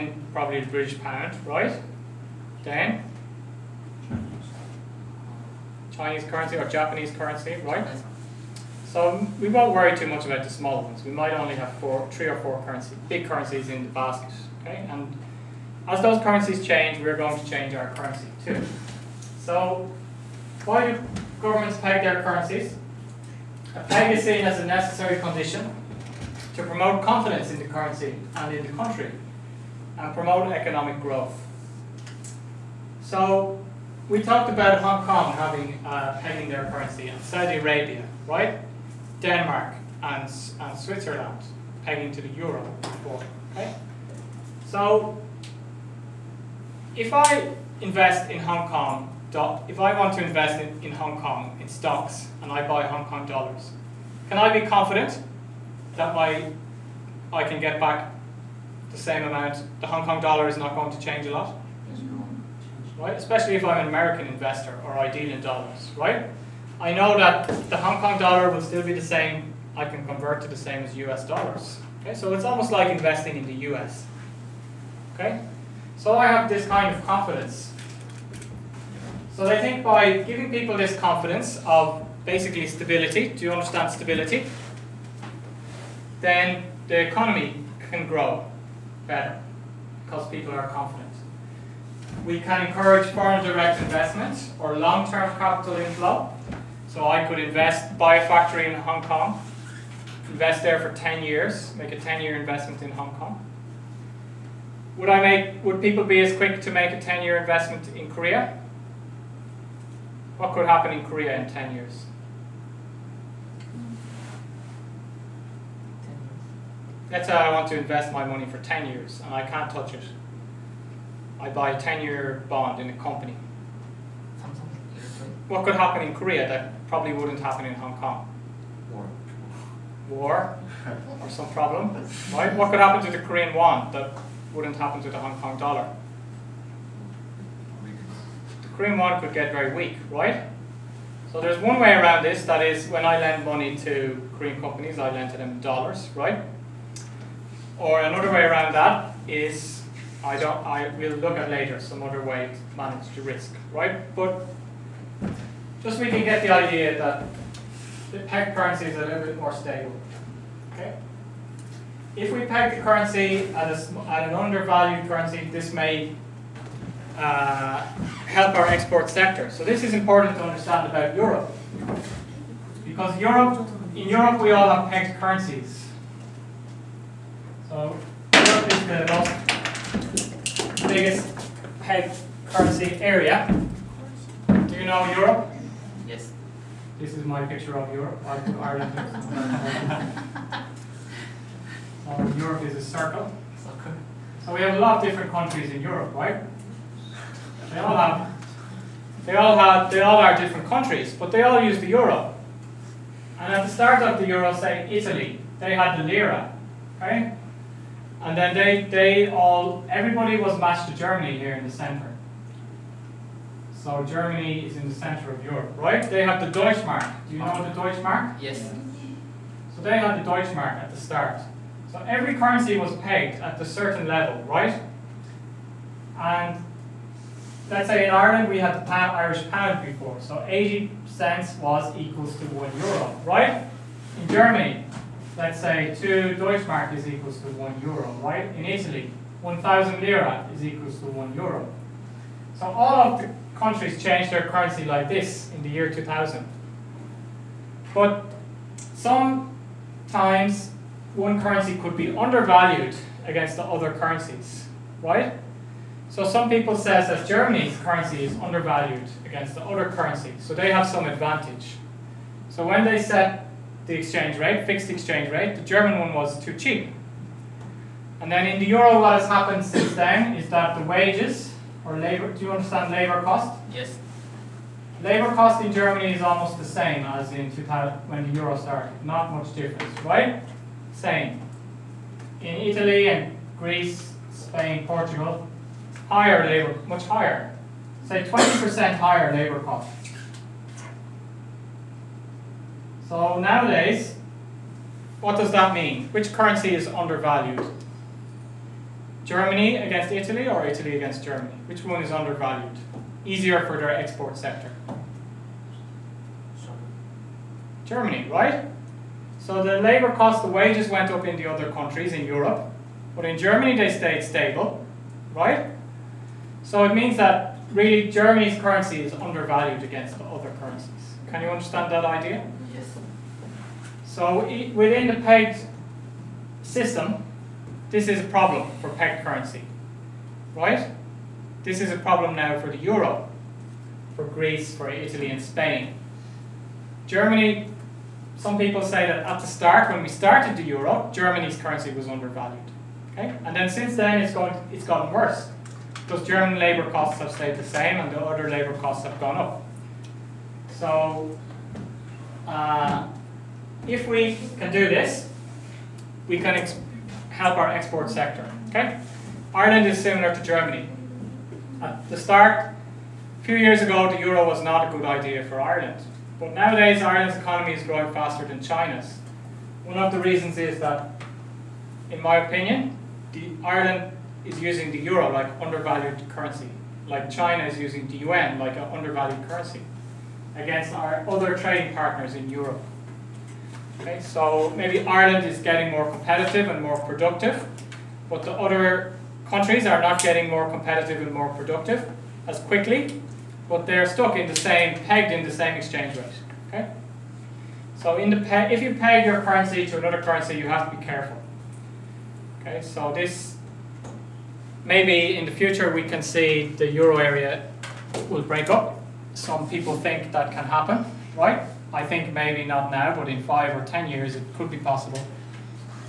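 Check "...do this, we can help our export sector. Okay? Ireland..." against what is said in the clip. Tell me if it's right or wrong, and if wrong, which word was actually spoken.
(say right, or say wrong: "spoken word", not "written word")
right.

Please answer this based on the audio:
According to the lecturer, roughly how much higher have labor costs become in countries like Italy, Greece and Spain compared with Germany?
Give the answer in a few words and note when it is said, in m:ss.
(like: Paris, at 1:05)
20%, at 4:48.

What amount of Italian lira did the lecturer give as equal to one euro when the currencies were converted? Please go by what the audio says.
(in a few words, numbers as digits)
1,000 lira.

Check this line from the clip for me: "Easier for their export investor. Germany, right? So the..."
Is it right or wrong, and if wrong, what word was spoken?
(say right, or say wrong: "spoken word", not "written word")
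wrong: "sector", not "investor".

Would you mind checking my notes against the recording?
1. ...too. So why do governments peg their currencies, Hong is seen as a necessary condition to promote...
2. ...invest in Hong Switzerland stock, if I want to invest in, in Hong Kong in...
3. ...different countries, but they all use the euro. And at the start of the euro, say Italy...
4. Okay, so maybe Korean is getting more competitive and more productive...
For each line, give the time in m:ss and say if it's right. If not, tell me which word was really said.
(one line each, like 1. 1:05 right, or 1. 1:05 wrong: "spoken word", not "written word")
1. 0:18 wrong: "Peg", not "Hong"
2. 0:47 wrong: "Kong", not "Switzerland"
3. 3:20 right
4. 6:24 wrong: "Ireland", not "Korean".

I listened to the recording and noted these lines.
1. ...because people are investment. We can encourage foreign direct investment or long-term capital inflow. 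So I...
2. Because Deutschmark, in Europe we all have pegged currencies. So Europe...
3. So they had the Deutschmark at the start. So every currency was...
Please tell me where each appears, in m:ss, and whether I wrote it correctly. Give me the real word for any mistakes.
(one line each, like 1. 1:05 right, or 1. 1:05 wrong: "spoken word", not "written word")
1. 1:30 wrong: "confident", not "investment"
2. 2:52 wrong: "Europe", not "Deutschmark"
3. 3:39 right.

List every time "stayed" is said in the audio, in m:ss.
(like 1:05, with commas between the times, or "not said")
5:13, 5:47.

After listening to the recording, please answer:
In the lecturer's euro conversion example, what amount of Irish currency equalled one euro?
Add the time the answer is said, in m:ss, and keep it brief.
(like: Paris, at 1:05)
80 cents, at 3:50.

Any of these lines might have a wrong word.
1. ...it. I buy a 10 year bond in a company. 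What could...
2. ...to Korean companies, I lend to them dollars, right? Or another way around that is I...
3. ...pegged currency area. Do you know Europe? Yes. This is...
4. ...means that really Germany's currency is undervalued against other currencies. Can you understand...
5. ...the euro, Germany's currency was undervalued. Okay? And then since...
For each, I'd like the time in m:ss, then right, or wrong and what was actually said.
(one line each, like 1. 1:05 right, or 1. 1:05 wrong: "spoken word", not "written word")
1. 1:59 right
2. 2:23 right
3. 3:01 right
4. 5:16 right
5. 5:40 right.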